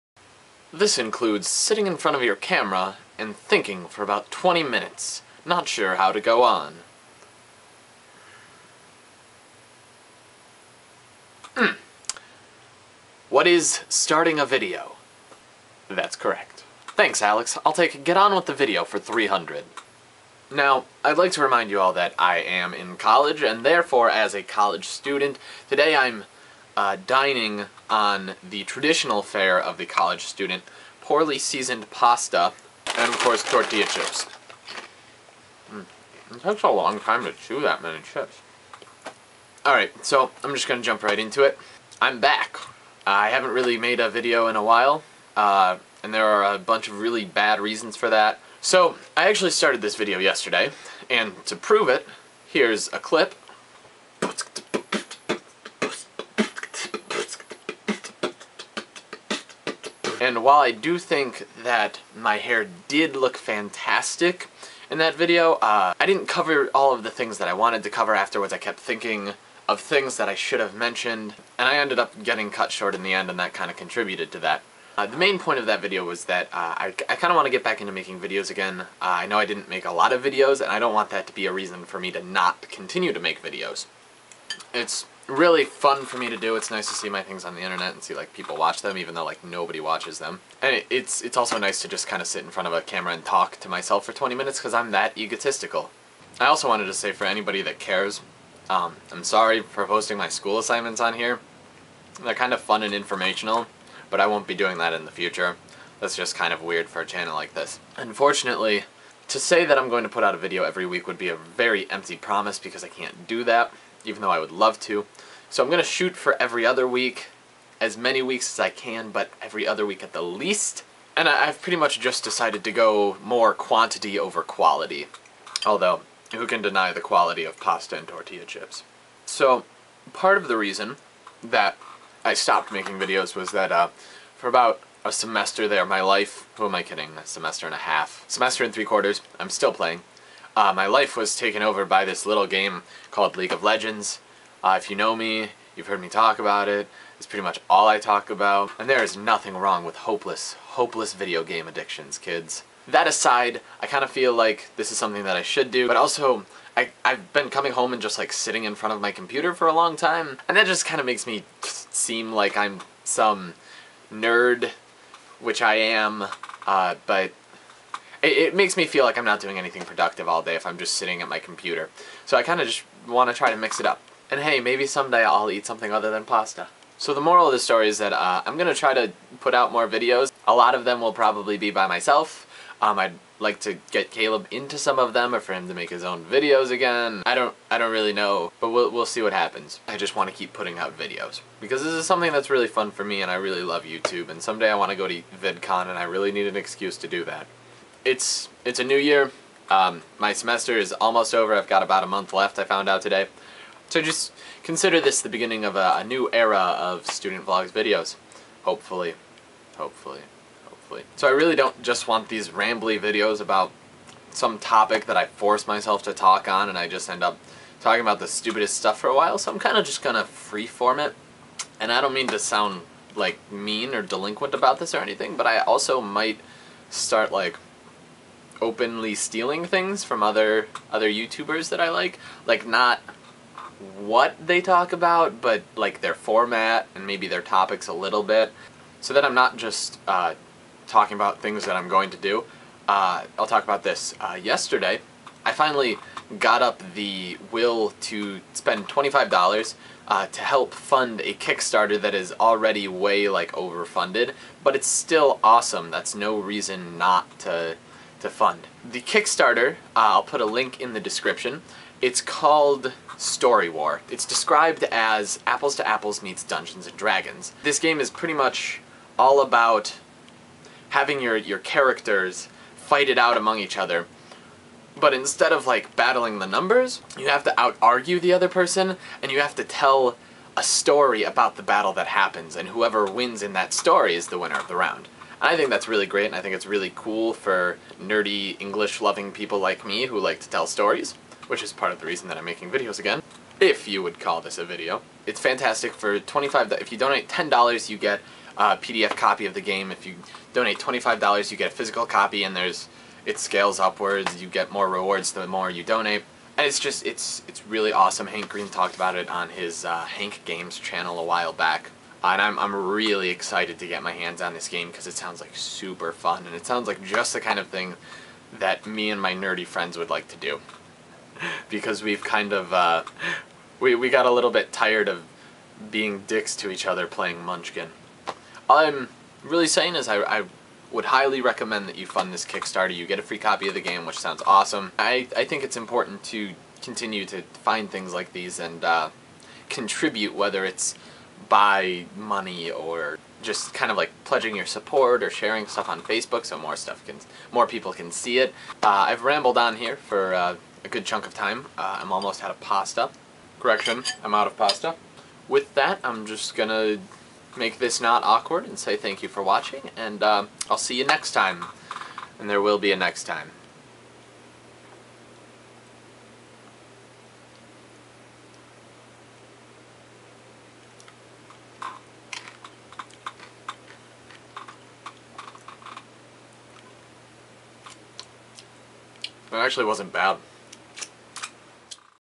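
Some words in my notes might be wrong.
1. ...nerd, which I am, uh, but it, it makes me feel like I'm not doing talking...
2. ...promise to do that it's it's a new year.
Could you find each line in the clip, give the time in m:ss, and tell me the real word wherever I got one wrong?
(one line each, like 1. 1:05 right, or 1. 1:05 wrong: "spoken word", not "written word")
1. 2:44 wrong: "anything", not "talking"
2. 3:16 wrong: "excuse", not "promise".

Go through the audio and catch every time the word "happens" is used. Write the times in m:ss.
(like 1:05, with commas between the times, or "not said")
3:09, 4:42.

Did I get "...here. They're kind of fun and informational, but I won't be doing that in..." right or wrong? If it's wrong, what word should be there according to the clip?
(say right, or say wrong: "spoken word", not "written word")
right.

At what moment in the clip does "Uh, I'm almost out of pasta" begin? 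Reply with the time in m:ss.
5:51.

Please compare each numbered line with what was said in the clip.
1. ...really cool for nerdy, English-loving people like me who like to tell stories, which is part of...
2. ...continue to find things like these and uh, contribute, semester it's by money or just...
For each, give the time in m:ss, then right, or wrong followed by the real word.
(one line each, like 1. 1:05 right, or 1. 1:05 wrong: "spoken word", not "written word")
1. 4:46 right
2. 5:36 wrong: "whether", not "semester".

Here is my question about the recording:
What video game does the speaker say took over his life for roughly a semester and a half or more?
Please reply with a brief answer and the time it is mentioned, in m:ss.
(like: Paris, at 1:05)
League of Legends, at 2:23.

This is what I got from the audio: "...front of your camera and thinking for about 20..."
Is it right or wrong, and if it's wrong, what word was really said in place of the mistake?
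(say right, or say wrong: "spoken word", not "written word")
right.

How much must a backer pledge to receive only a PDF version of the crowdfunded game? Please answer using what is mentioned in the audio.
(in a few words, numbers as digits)
$10.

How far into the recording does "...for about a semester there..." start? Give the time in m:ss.
2:14.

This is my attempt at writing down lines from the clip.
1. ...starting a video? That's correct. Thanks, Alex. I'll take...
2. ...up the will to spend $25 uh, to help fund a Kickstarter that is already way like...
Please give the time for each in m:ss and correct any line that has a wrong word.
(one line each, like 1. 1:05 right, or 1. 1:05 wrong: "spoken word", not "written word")
1. 0:13 right
2. 4:06 right.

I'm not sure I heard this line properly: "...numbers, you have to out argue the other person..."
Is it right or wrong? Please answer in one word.
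right.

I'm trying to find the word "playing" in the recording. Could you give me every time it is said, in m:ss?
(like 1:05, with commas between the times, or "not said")
2:19, 5:27.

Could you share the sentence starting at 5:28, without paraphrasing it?
All I'm really saying is I, I would highly recommend that you fund this Kickstarter.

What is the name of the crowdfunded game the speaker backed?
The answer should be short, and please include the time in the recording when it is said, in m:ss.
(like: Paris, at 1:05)
Story War, at 4:23.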